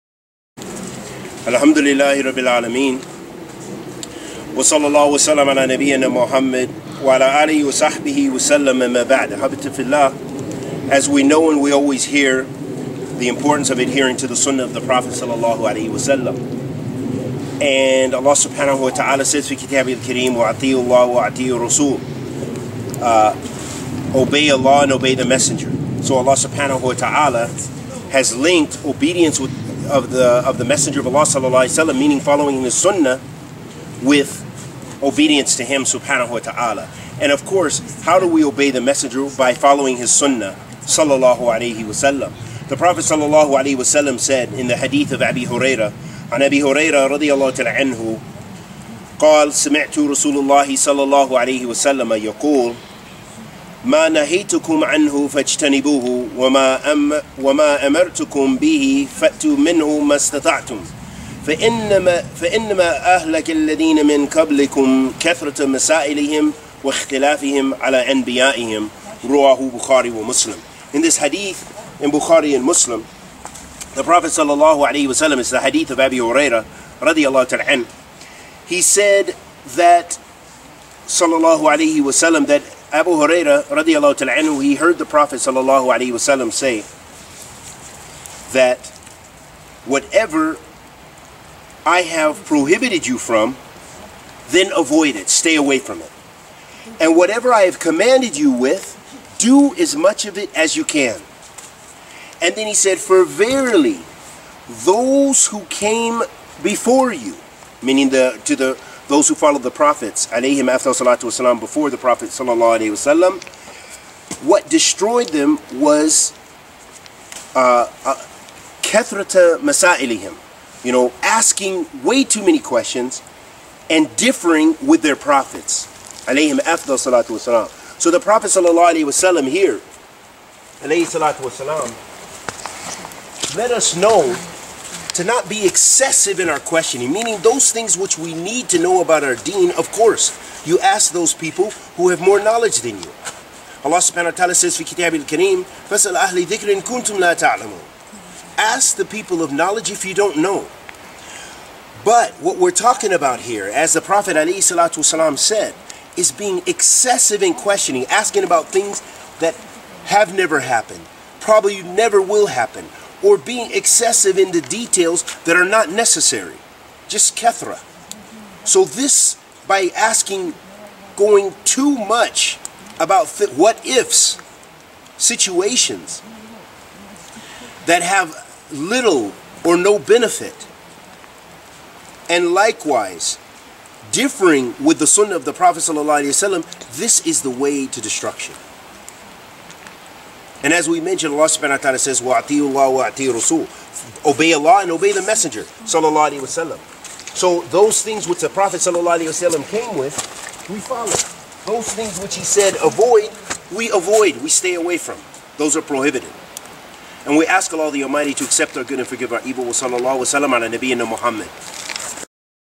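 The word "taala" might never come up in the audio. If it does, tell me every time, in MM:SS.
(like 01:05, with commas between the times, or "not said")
00:36.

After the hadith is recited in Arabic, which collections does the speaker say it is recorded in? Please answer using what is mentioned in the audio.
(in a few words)
Bukhari and Muslim.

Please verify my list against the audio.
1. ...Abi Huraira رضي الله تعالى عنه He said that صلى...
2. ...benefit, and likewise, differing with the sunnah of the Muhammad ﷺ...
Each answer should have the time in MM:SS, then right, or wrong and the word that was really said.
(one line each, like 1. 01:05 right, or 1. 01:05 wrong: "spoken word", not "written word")
1. 01:15 right
2. 02:59 wrong: "Prophet", not "Muhammad".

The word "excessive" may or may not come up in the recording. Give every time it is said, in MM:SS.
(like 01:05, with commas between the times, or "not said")
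02:15, 02:36, 02:43.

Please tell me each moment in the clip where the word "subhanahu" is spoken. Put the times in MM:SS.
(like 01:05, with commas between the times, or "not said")
00:18, 00:26, 00:35, 02:23, 03:11.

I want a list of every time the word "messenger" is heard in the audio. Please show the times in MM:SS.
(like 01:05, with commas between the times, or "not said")
00:25, 00:30, 00:38, 03:15.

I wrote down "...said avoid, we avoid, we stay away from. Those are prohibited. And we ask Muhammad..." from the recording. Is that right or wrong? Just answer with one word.
wrong.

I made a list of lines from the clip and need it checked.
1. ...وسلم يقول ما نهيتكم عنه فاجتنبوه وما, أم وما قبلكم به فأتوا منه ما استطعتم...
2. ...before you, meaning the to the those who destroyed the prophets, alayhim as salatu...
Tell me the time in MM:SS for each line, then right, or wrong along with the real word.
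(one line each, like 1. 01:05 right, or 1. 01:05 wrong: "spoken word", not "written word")
1. 00:51 wrong: "أمرتكم", not "قبلكم"
2. 01:46 wrong: "followed", not "destroyed".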